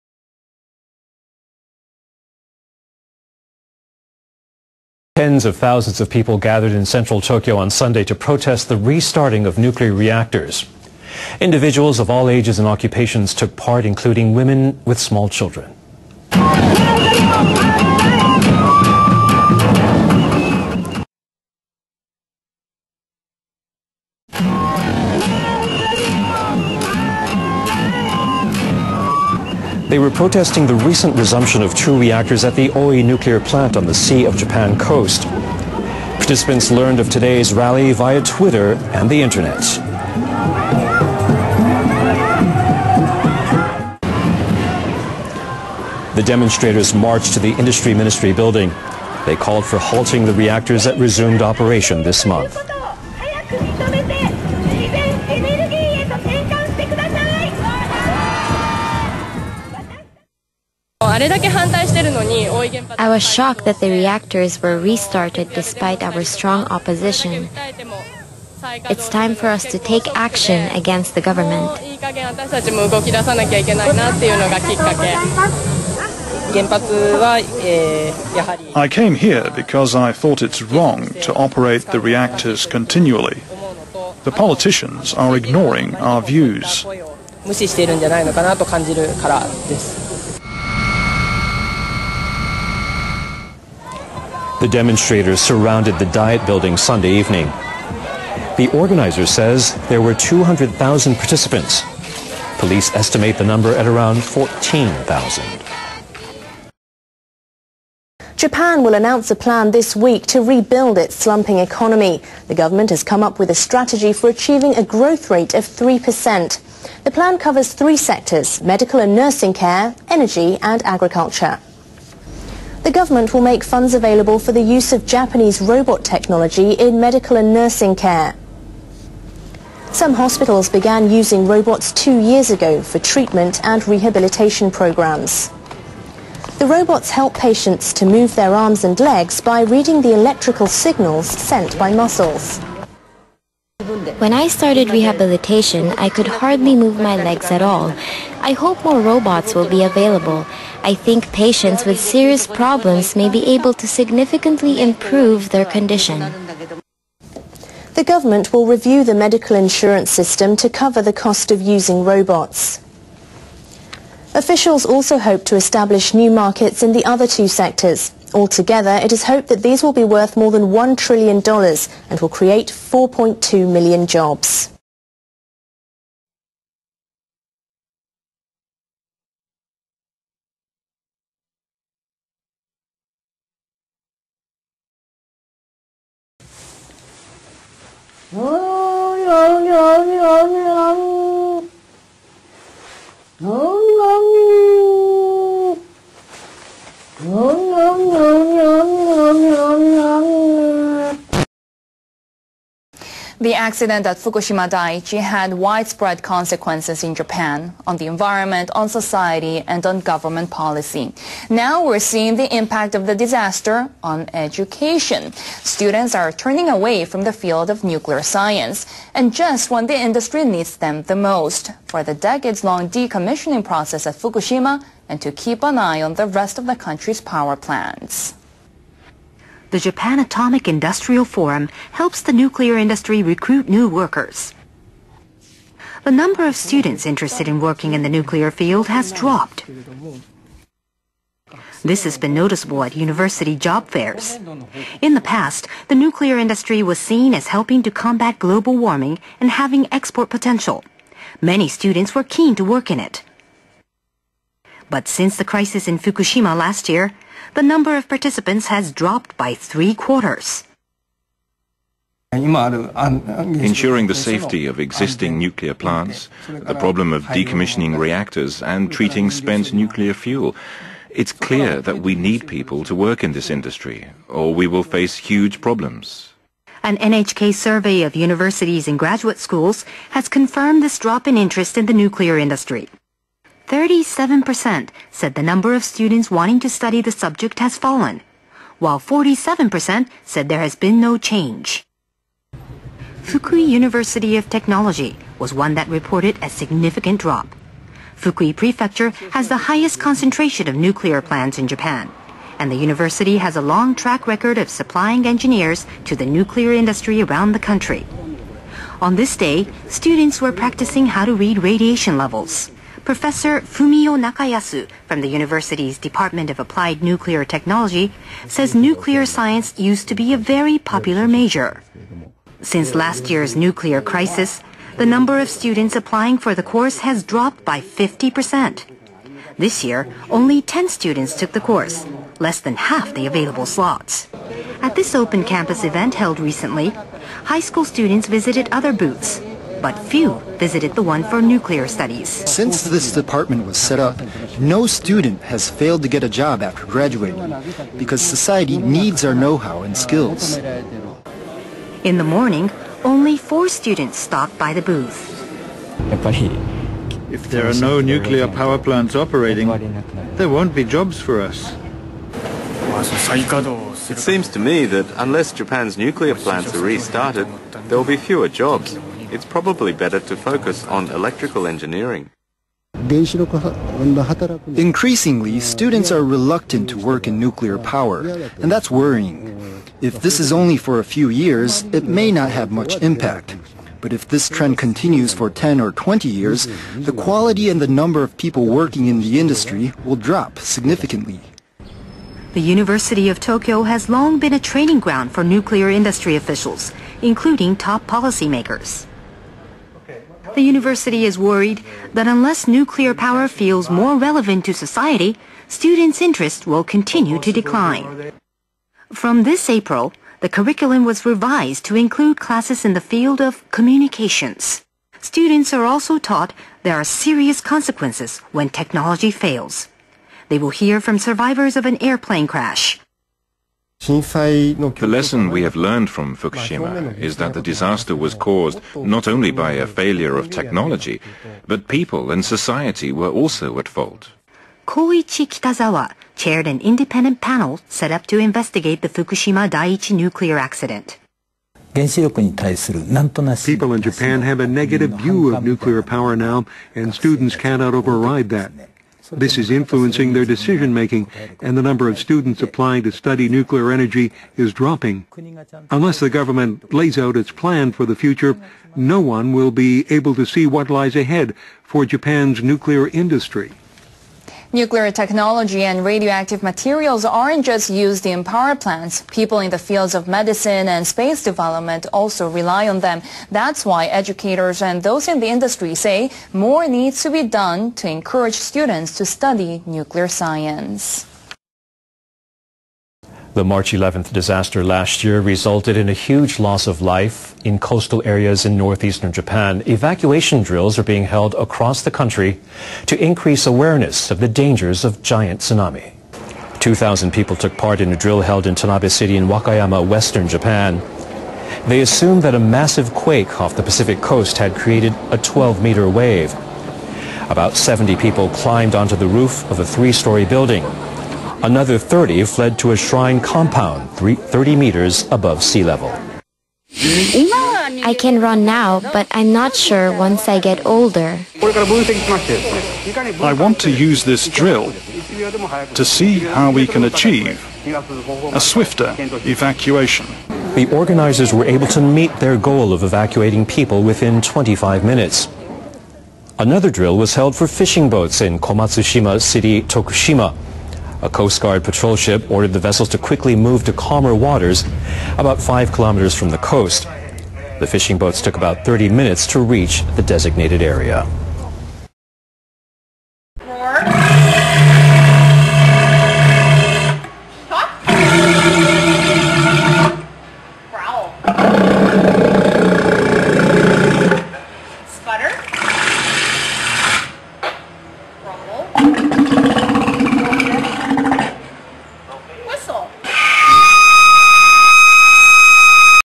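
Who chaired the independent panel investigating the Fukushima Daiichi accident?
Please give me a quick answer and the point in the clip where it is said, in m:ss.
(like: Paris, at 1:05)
Koichi Kitazawa, at 7:14.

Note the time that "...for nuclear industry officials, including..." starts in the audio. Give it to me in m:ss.
6:35.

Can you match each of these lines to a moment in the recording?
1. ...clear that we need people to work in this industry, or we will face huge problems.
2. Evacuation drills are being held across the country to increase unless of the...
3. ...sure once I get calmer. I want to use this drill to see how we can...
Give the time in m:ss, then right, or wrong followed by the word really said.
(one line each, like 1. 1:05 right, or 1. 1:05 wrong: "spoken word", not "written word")
1. 4:31 right
2. 8:09 wrong: "awareness", not "unless"
3. 8:39 wrong: "older", not "calmer".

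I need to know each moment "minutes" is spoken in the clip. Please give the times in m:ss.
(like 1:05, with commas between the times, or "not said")
8:55, 9:09.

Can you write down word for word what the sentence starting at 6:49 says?
From this April, the curriculum was revised to include classes in the field of communications.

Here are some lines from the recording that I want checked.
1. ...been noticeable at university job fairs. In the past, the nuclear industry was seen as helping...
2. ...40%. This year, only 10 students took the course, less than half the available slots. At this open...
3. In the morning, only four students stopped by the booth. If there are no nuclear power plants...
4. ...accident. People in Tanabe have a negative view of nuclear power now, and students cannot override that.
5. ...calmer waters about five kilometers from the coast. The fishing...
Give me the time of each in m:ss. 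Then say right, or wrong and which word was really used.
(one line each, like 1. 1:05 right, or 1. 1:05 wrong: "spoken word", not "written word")
1. 4:02 right
2. 5:27 wrong: "50", not "40"
3. 5:52 right
4. 7:20 wrong: "Japan", not "Tanabe"
5. 9:03 right.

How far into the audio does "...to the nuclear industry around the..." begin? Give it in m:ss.
5:06.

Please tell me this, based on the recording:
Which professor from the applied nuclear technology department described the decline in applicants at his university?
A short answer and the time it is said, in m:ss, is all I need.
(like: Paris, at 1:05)
Fumio Nakayasu, at 5:13.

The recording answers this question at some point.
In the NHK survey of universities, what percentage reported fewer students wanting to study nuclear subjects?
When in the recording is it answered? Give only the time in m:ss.
4:43.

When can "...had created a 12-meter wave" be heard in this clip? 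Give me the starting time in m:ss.
8:24.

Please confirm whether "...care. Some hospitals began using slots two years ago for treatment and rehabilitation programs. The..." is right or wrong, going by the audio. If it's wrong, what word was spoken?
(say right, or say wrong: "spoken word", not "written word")
wrong: "robots", not "slots".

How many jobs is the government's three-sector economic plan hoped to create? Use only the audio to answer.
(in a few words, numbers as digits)
4.2 million.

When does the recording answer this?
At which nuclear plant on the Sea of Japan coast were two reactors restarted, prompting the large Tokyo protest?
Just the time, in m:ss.
0:32.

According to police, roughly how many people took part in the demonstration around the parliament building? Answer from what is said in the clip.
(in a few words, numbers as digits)
14,000.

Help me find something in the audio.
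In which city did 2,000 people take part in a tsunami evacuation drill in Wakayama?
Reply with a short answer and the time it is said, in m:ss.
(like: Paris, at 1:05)
Tanabe, at 8:18.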